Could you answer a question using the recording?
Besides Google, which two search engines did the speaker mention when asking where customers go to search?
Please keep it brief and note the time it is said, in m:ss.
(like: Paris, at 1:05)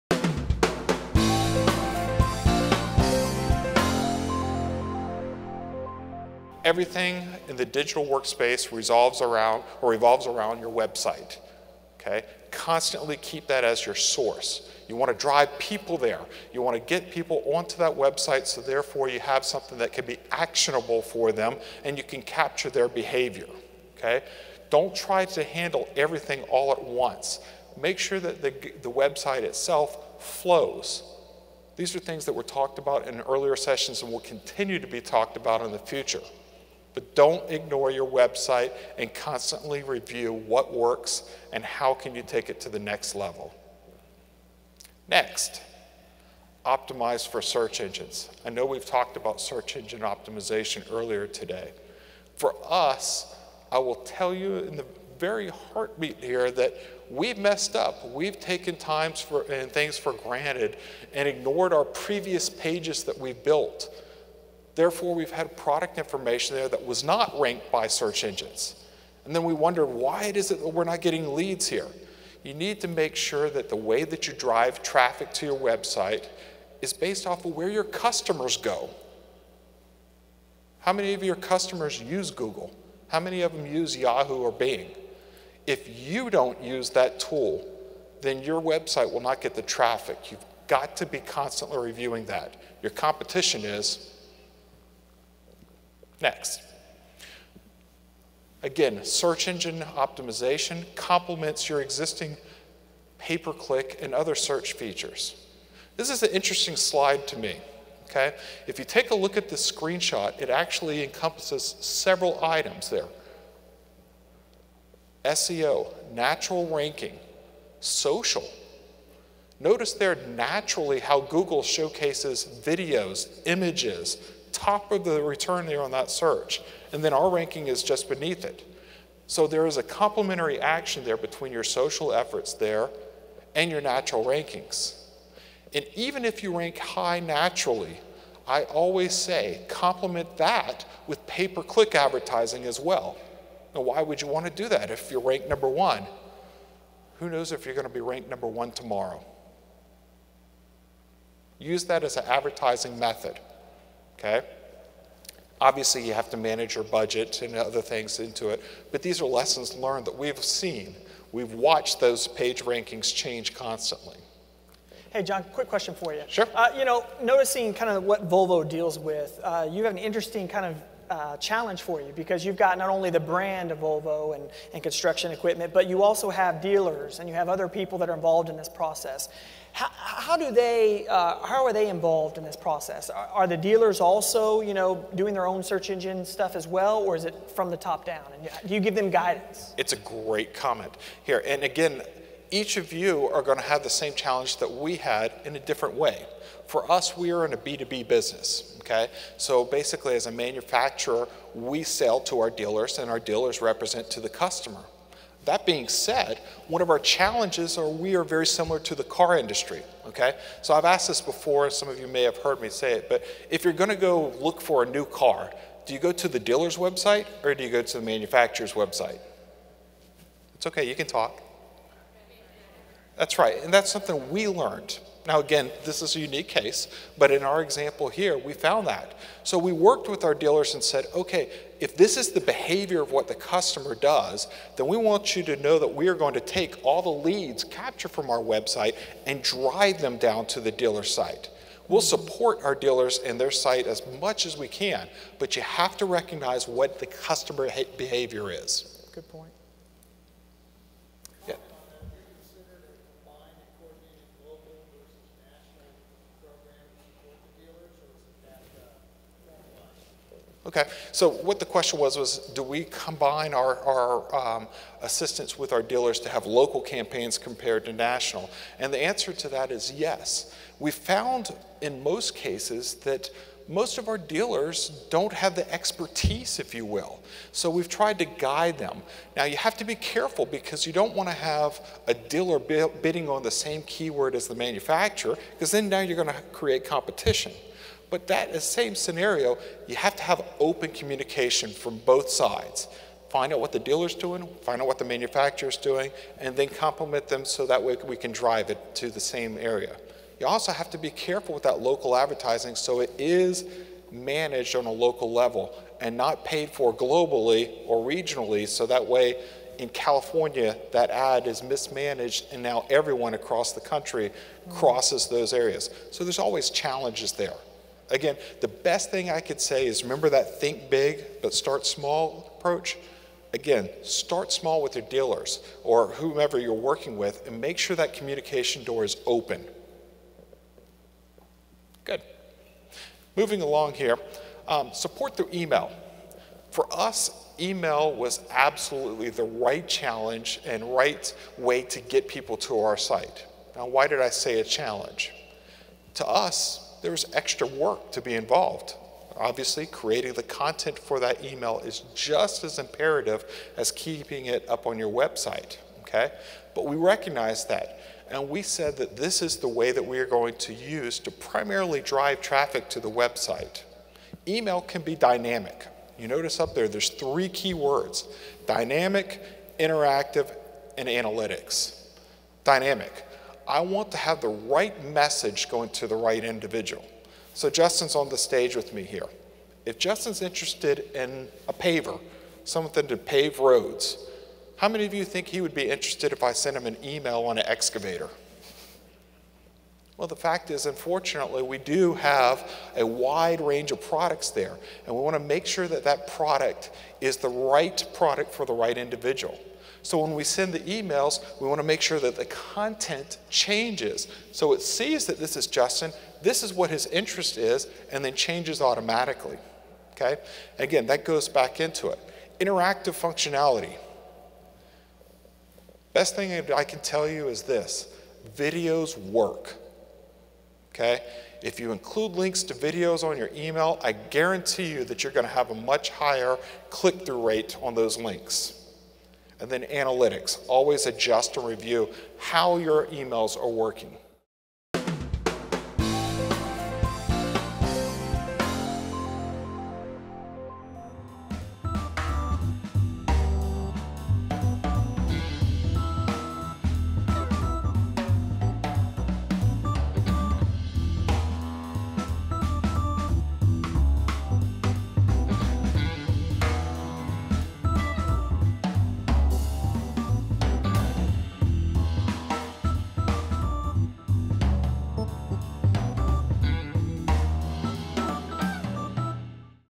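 Yahoo or Bing, at 1:23.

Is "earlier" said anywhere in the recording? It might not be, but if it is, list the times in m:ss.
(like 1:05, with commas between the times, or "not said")
0:33, 0:50.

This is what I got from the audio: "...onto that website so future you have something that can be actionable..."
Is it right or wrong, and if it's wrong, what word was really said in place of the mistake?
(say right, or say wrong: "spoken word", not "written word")
wrong: "therefore", not "future".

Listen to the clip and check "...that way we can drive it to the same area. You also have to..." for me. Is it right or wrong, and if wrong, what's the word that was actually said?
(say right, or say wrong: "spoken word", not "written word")
right.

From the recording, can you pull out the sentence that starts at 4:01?
We'll support our dealers and their site as much as we can, but you have to recognize what the customer behavior is.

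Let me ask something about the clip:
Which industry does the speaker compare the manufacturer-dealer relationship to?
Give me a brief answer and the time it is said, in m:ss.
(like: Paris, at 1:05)
car industry, at 3:29.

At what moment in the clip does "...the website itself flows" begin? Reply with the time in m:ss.
0:28.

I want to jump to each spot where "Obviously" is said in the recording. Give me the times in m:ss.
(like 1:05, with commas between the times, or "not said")
2:35, 5:49.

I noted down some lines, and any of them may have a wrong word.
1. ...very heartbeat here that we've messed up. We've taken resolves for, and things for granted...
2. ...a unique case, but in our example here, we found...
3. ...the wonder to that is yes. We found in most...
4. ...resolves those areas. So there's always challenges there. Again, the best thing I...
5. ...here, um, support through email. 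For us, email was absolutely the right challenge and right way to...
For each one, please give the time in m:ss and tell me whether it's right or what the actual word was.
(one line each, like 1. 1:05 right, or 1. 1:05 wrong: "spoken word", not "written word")
1. 0:55 wrong: "times", not "resolves"
2. 3:46 right
3. 4:28 wrong: "answer", not "wonder"
4. 5:14 wrong: "crosses", not "resolves"
5. 5:33 right.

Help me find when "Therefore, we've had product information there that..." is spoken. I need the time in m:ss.
1:04.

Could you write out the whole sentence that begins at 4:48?
But that same scenario, you have to have open communication from both sides.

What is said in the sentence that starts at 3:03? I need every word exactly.
Are, are, the dealers also, you know, doing their own search engine stuff as well, or is it from the top down?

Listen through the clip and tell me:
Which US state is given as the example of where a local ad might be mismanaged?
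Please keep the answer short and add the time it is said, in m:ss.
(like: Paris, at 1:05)
California, at 5:09.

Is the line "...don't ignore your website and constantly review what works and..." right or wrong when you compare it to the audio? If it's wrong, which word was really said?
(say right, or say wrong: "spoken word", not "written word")
right.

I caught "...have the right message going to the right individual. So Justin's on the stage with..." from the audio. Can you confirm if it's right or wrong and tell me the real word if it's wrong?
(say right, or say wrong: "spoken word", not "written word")
right.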